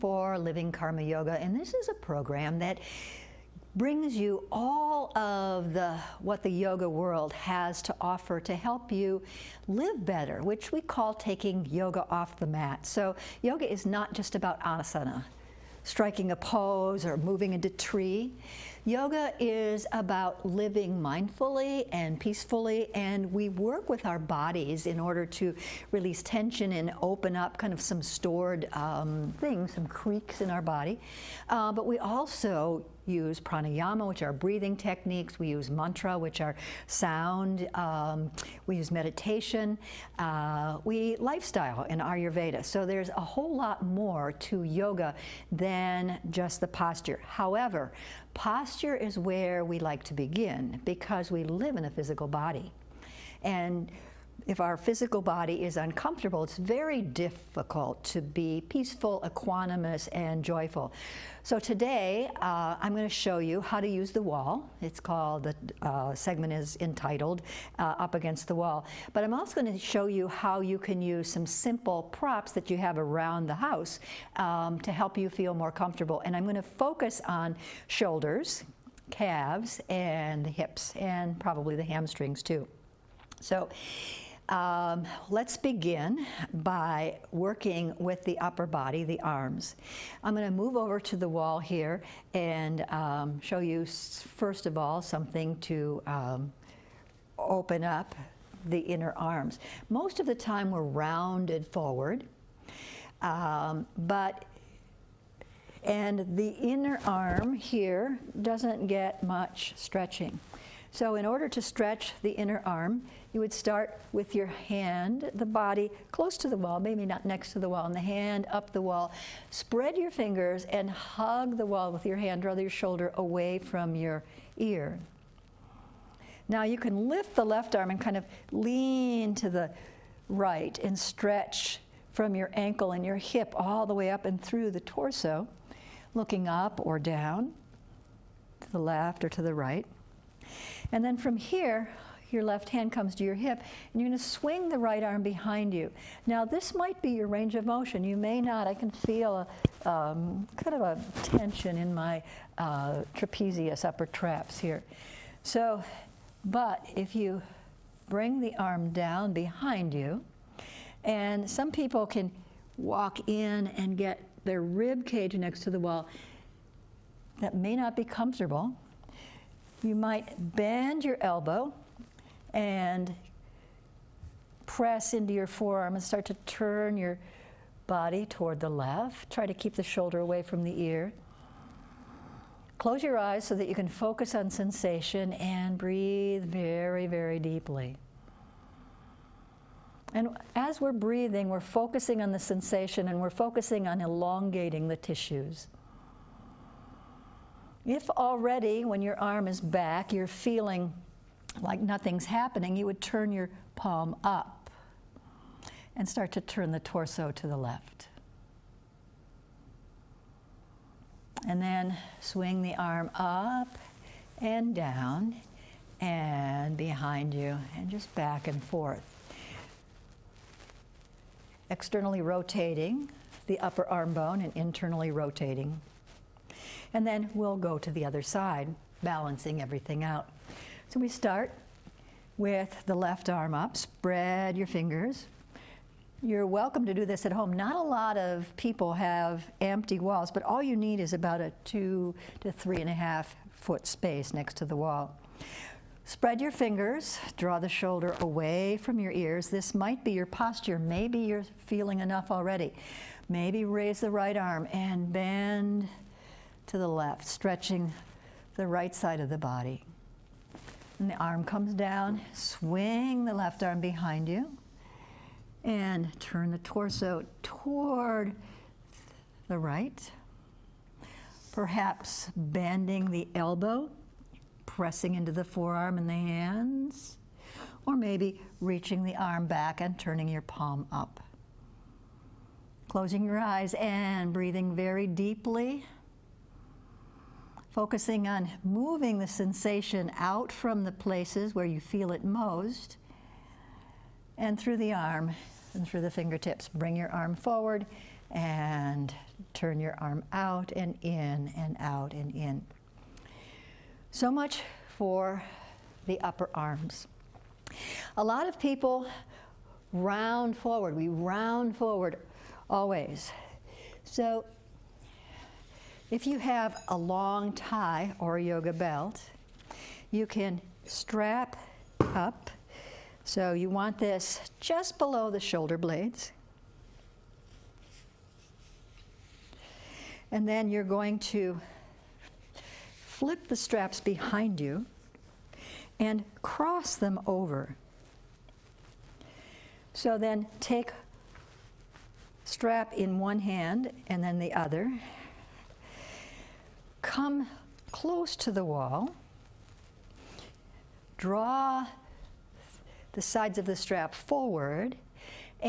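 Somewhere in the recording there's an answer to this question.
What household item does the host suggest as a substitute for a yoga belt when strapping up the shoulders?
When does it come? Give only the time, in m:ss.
5:16.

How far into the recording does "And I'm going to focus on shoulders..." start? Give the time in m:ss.
1:16.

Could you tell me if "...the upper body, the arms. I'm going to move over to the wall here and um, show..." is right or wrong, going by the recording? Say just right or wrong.
right.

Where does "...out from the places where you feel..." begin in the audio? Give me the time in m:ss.
4:50.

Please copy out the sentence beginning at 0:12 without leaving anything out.
So yoga is not just about asana, striking a pose or moving into tree.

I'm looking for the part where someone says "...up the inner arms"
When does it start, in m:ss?
1:37.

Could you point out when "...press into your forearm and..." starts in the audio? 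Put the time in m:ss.
2:54.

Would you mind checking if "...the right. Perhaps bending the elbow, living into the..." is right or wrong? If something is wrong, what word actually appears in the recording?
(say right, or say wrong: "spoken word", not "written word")
wrong: "pressing", not "living".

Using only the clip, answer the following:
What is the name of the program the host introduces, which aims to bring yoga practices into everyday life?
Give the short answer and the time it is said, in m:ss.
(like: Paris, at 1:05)
Living Karma Yoga, at 0:00.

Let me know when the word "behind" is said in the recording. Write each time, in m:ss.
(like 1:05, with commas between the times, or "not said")
2:25, 2:39, 3:36, 4:23, 5:33.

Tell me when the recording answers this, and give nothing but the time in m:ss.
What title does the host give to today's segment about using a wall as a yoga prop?
1:07.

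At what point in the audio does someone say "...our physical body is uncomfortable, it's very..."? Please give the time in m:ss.
0:54.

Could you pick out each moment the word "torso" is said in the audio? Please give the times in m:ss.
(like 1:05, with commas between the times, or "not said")
2:14, 3:26, 4:26.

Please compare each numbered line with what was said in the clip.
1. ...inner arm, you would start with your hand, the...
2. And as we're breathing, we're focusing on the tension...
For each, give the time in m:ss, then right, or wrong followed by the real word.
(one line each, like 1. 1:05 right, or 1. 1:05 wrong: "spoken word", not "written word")
1. 1:52 right
2. 3:10 wrong: "sensation", not "tension".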